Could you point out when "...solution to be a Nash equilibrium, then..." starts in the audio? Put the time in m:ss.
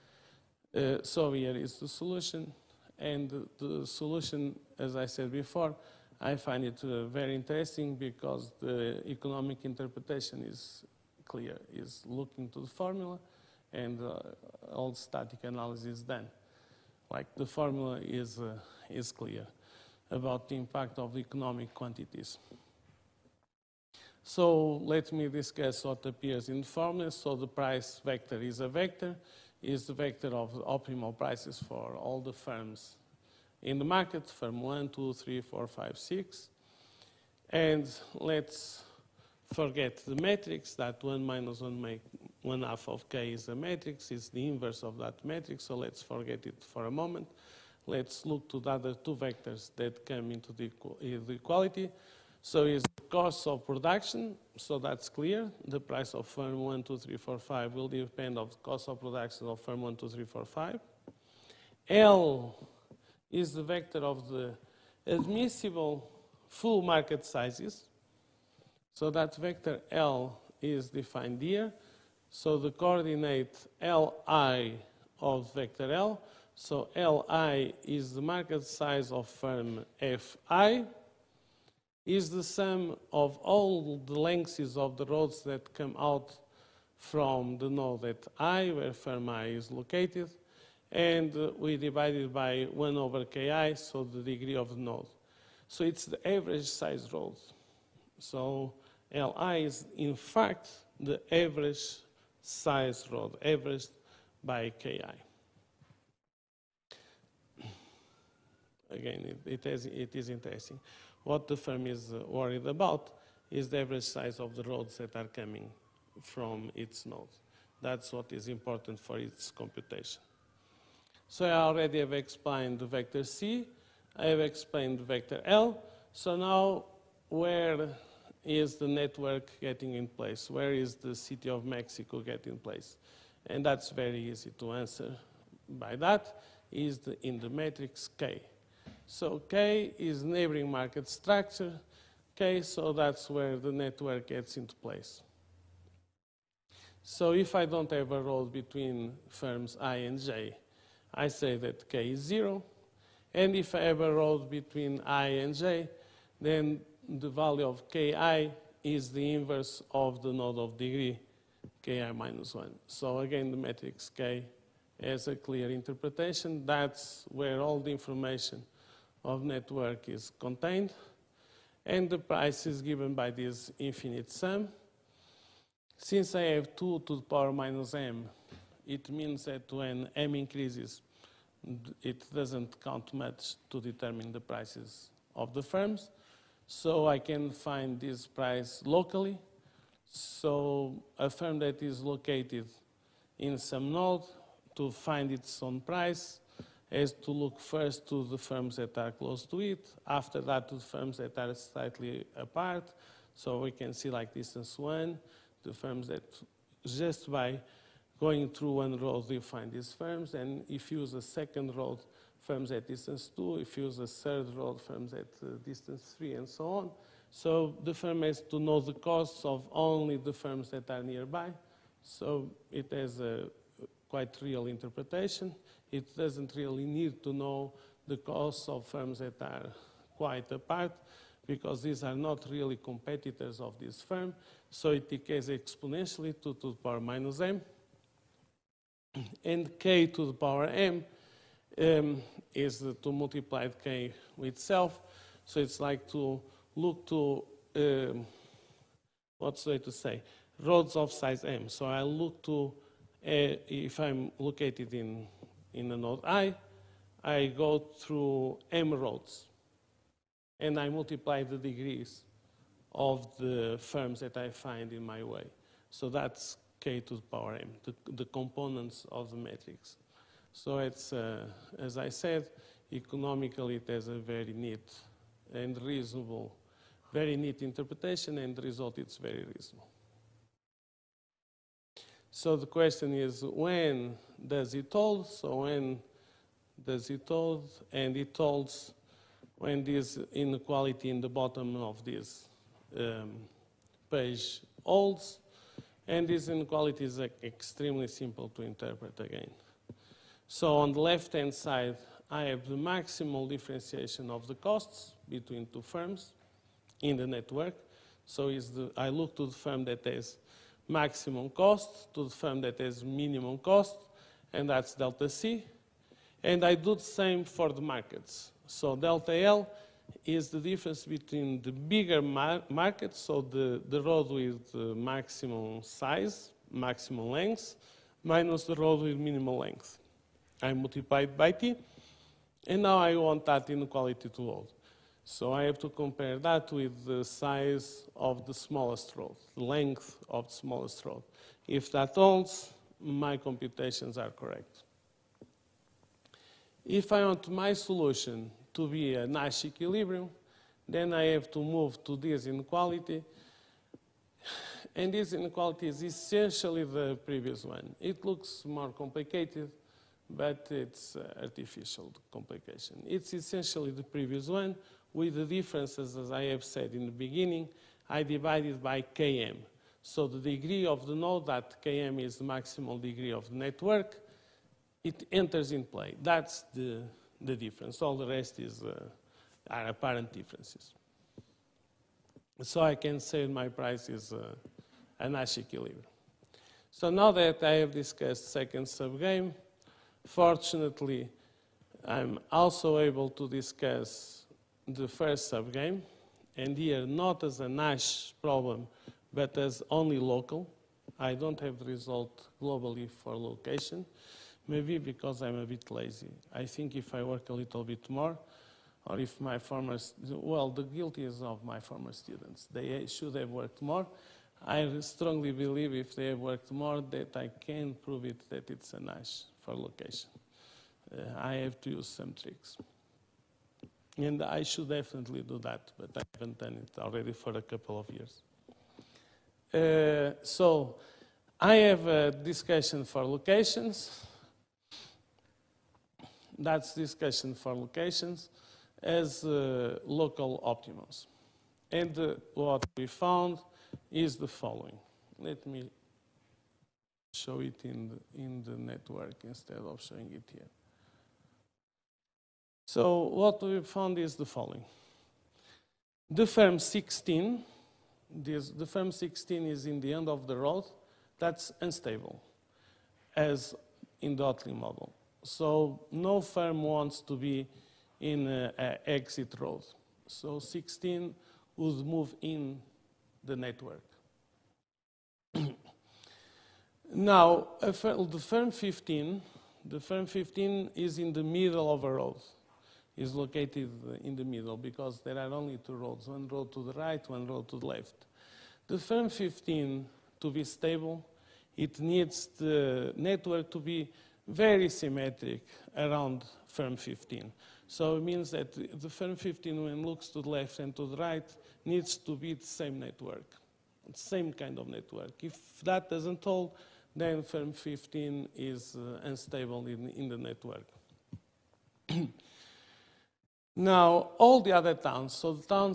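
5:47.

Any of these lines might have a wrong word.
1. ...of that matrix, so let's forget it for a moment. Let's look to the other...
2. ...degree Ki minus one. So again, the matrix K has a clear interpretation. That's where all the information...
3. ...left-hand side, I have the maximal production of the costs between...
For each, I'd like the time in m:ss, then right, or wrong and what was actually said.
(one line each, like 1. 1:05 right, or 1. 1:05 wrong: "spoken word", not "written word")
1. 0:44 right
2. 2:40 right
3. 5:01 wrong: "differentiation", not "production".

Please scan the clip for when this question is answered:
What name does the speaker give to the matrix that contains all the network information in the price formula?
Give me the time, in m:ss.
2:20.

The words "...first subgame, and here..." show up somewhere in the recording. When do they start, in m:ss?
6:35.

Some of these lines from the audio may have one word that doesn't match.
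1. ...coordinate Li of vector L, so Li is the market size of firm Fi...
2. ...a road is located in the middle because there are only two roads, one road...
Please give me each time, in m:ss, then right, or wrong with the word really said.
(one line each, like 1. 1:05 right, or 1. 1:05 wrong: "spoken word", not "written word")
1. 1:12 right
2. 8:02 right.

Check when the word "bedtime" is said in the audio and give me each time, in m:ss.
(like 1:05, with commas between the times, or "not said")
not said.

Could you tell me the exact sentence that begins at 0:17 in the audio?
Like the formula is, uh, is clear about the impact of the economic quantities.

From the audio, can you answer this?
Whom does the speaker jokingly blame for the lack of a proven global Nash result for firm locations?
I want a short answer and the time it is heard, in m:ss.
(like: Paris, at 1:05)
former students, at 6:51.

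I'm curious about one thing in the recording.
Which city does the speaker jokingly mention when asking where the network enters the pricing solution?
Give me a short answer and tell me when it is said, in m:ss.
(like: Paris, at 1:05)
Mexico, at 2:11.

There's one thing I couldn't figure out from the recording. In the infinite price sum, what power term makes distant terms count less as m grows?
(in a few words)
2 to the power minus m.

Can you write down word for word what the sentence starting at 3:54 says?
So it decays exponentially to, to the power minus m.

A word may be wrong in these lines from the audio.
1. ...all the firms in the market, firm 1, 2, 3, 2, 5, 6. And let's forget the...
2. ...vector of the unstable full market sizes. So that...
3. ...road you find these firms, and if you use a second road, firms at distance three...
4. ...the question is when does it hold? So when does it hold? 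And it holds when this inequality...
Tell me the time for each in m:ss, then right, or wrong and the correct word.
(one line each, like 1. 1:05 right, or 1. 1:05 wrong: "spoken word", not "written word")
1. 0:31 wrong: "4", not "2"
2. 1:03 wrong: "admissible", not "unstable"
3. 3:28 wrong: "two", not "three"
4. 4:42 right.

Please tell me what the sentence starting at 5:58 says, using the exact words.
It looks more complicated, but it's artificial complication.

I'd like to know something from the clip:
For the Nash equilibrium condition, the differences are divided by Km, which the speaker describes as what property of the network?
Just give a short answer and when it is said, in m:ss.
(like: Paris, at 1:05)
maximal degree, at 6:12.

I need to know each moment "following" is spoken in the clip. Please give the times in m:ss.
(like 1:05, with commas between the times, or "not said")
7:24, 7:34.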